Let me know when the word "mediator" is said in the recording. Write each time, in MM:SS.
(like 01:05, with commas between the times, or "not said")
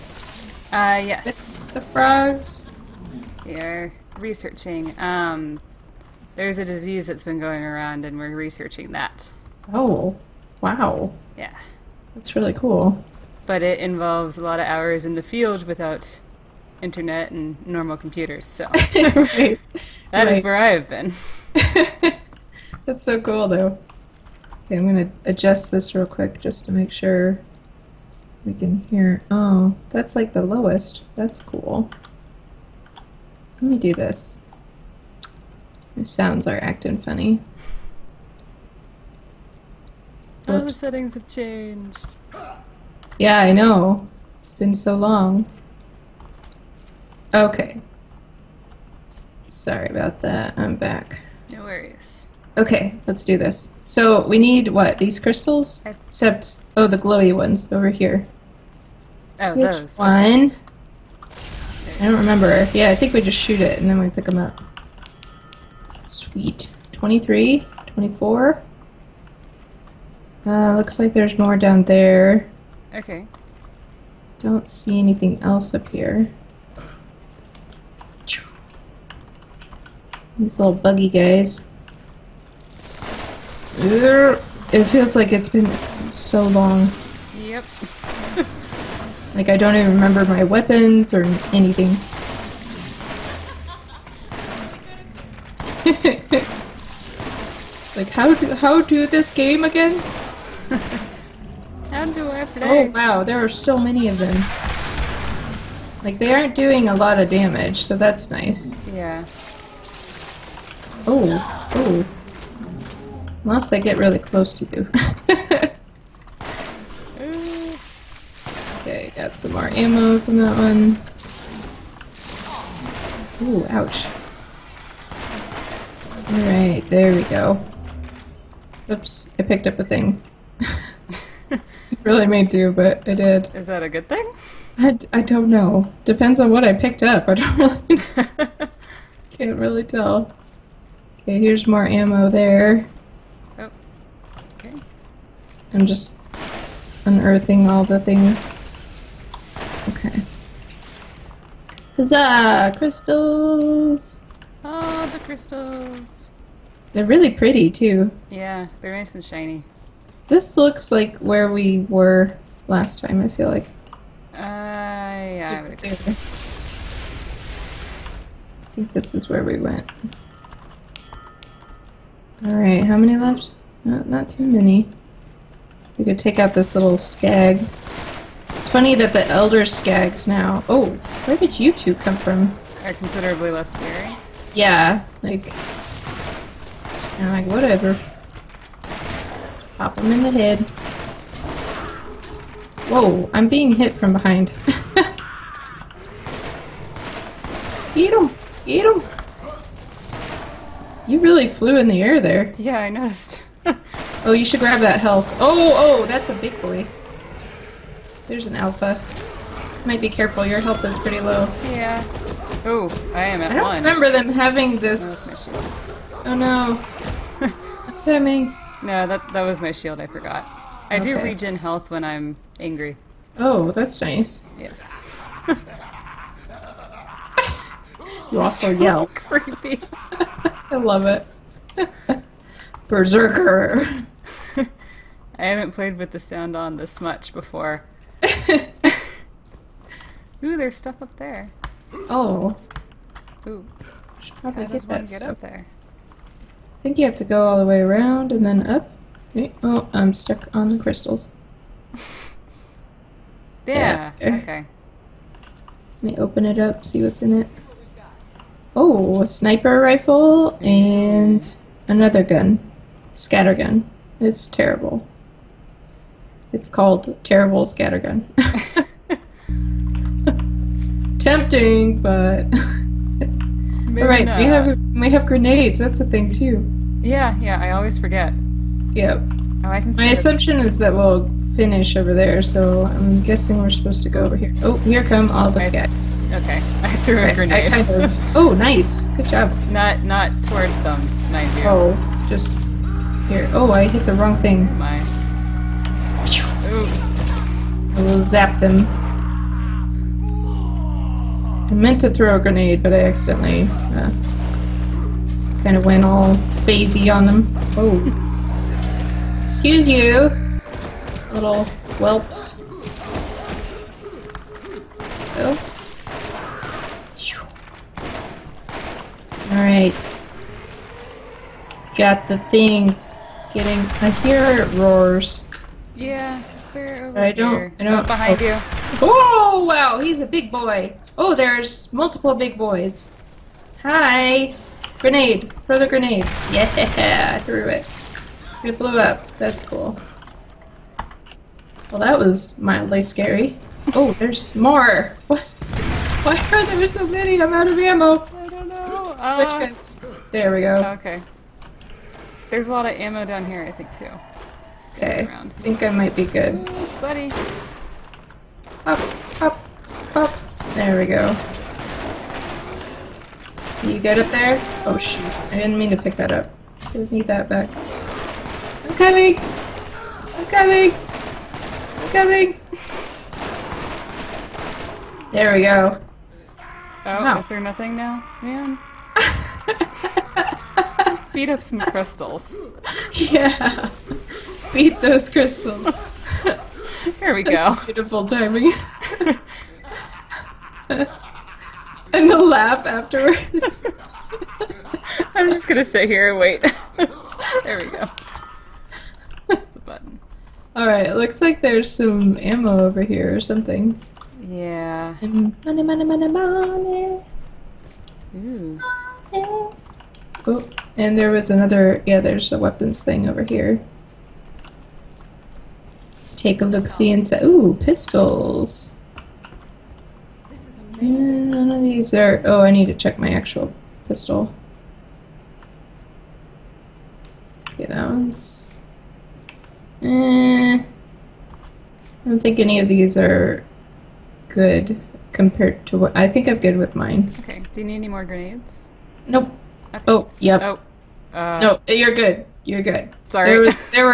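not said.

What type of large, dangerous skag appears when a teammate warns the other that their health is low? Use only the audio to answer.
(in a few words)
An alpha.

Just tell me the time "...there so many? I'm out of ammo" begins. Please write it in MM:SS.
05:46.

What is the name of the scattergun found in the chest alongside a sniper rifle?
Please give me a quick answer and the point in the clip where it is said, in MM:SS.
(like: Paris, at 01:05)
Terrible Scattergun, at 04:27.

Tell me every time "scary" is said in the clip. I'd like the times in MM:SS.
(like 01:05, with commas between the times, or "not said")
03:03, 05:43.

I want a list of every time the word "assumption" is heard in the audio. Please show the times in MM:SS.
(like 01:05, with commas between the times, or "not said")
04:40.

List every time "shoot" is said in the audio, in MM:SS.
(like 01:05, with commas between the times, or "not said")
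01:03, 06:04.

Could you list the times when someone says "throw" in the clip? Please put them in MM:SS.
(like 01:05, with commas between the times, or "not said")
05:02, 05:35.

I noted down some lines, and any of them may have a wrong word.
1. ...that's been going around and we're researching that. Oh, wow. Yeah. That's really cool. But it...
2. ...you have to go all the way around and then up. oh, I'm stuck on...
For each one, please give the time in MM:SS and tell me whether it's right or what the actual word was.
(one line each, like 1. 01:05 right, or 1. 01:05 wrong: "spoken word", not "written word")
1. 00:07 right
2. 04:06 right.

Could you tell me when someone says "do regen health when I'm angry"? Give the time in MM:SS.
03:41.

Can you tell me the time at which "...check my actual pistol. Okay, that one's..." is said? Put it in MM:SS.
07:02.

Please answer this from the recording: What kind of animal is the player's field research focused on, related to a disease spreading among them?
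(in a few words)
Frogs.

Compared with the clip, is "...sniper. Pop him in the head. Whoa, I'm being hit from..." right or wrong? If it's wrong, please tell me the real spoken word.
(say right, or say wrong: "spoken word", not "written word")
wrong: "whatever", not "sniper".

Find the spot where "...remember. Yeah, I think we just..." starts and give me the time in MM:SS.
01:02.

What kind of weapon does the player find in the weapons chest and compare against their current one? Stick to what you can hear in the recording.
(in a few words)
Pistols.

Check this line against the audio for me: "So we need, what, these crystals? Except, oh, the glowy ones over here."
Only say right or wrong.
right.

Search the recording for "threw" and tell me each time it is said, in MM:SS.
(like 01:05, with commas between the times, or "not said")
04:46, 05:37.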